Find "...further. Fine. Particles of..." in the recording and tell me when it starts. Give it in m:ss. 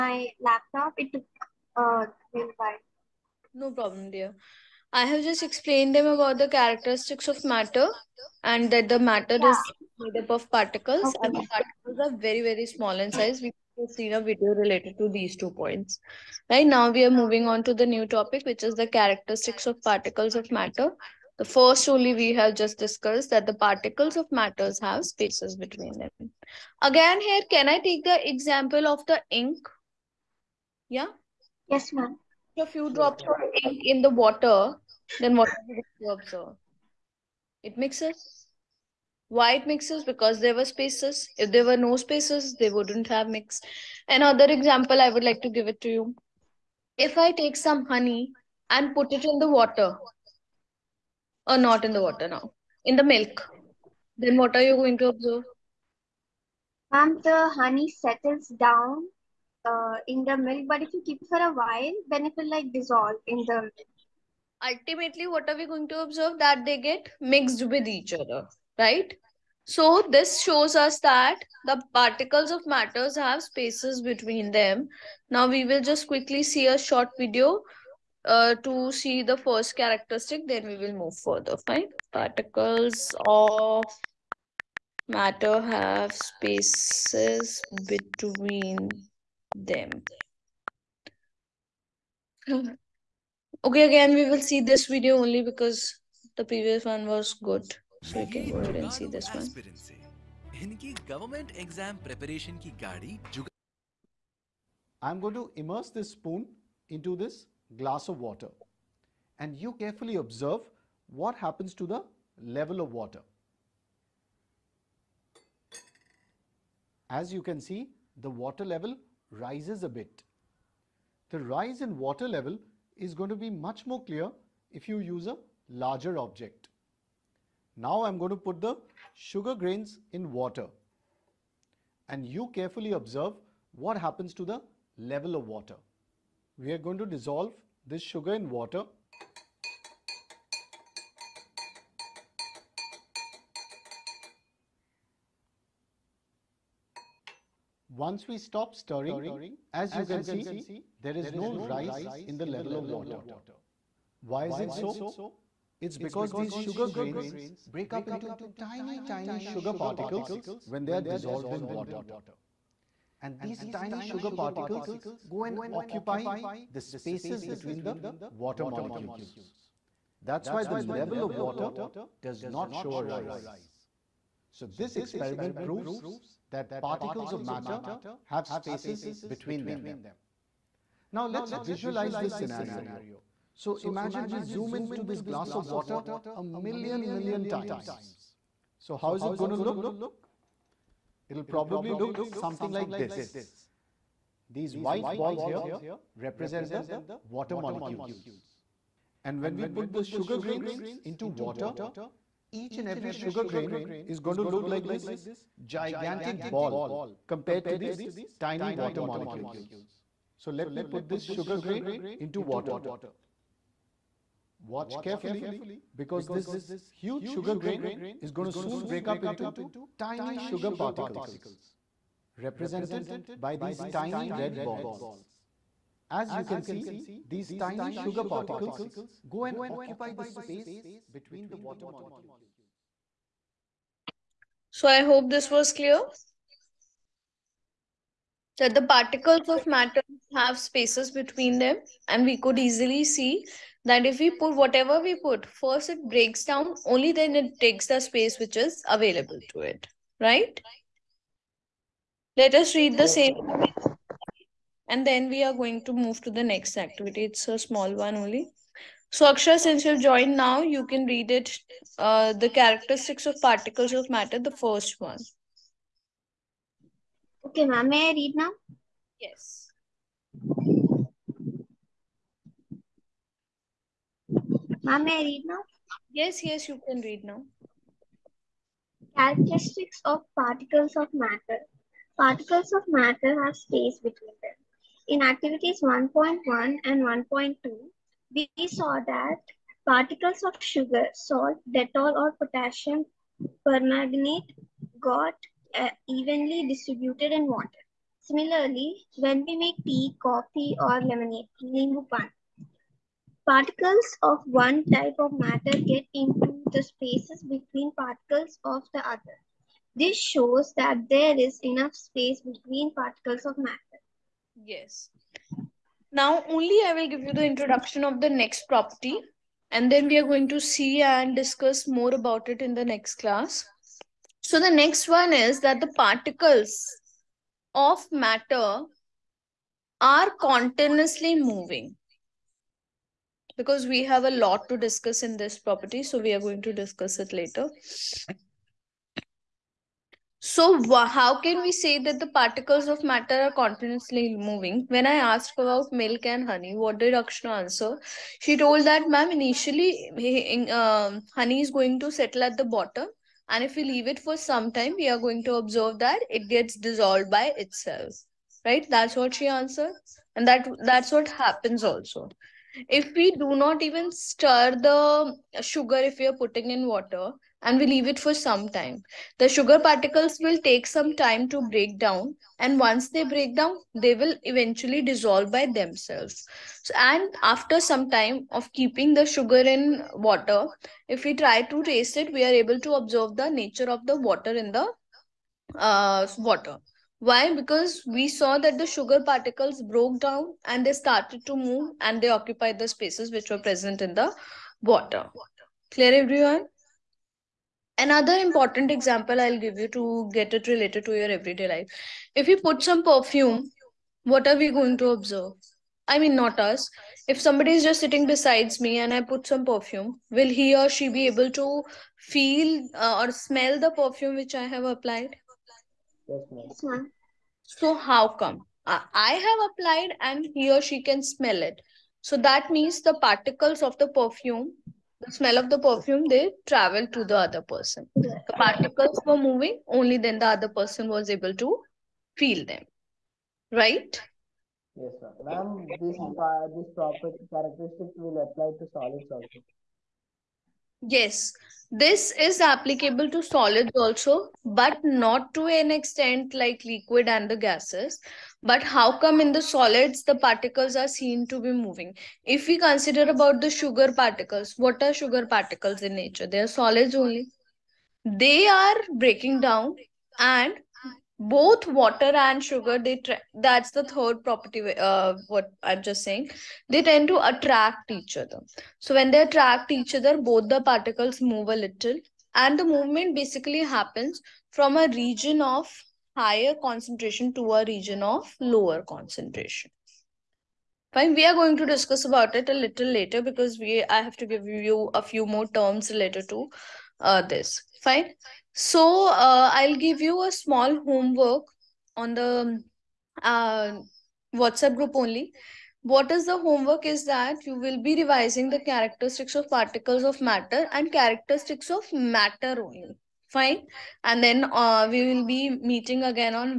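1:21.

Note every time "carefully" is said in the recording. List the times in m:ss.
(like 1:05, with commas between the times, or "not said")
1:49, 2:12, 3:35.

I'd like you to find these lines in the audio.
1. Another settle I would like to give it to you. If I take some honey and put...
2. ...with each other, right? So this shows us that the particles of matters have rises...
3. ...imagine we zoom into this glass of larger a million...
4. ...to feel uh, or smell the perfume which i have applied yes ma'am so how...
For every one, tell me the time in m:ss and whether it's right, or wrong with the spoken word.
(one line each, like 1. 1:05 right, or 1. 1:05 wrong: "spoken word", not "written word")
1. 0:44 wrong: "example", not "settle"
2. 1:07 wrong: "spaces", not "rises"
3. 3:03 wrong: "water", not "larger"
4. 6:51 right.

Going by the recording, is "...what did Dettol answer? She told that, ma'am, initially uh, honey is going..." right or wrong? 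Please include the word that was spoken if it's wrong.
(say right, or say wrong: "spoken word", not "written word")
wrong: "Akshna", not "Dettol".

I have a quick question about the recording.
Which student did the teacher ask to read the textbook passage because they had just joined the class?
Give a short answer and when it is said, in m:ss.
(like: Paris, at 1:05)
Akshar, at 4:19.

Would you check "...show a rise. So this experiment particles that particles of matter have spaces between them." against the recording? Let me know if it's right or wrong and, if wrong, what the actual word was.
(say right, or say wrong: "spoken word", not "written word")
wrong: "proves", not "particles".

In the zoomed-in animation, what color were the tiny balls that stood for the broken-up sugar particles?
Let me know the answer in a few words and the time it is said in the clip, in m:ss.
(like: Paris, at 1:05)
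Red, at 3:44.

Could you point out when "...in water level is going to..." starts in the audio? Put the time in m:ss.
2:01.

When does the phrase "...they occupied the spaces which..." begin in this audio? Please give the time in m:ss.
6:32.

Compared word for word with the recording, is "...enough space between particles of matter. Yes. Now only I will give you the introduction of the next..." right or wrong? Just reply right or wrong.
right.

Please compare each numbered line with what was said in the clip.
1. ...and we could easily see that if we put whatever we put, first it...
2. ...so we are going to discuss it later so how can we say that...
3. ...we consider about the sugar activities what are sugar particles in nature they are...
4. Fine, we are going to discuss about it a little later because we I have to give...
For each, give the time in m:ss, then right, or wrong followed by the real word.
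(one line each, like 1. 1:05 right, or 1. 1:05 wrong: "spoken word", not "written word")
1. 4:02 right
2. 5:36 right
3. 7:32 wrong: "particles", not "activities"
4. 8:01 right.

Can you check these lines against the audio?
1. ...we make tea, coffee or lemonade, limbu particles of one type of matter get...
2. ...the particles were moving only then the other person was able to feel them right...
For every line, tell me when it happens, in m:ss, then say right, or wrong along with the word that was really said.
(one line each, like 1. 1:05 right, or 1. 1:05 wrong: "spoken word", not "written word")
1. 4:59 right
2. 7:08 right.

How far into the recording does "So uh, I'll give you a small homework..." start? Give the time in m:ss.
8:08.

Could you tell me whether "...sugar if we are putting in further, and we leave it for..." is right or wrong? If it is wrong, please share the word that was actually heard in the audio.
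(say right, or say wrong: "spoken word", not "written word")
wrong: "water", not "further".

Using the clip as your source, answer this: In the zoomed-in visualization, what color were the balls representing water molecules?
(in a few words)
White.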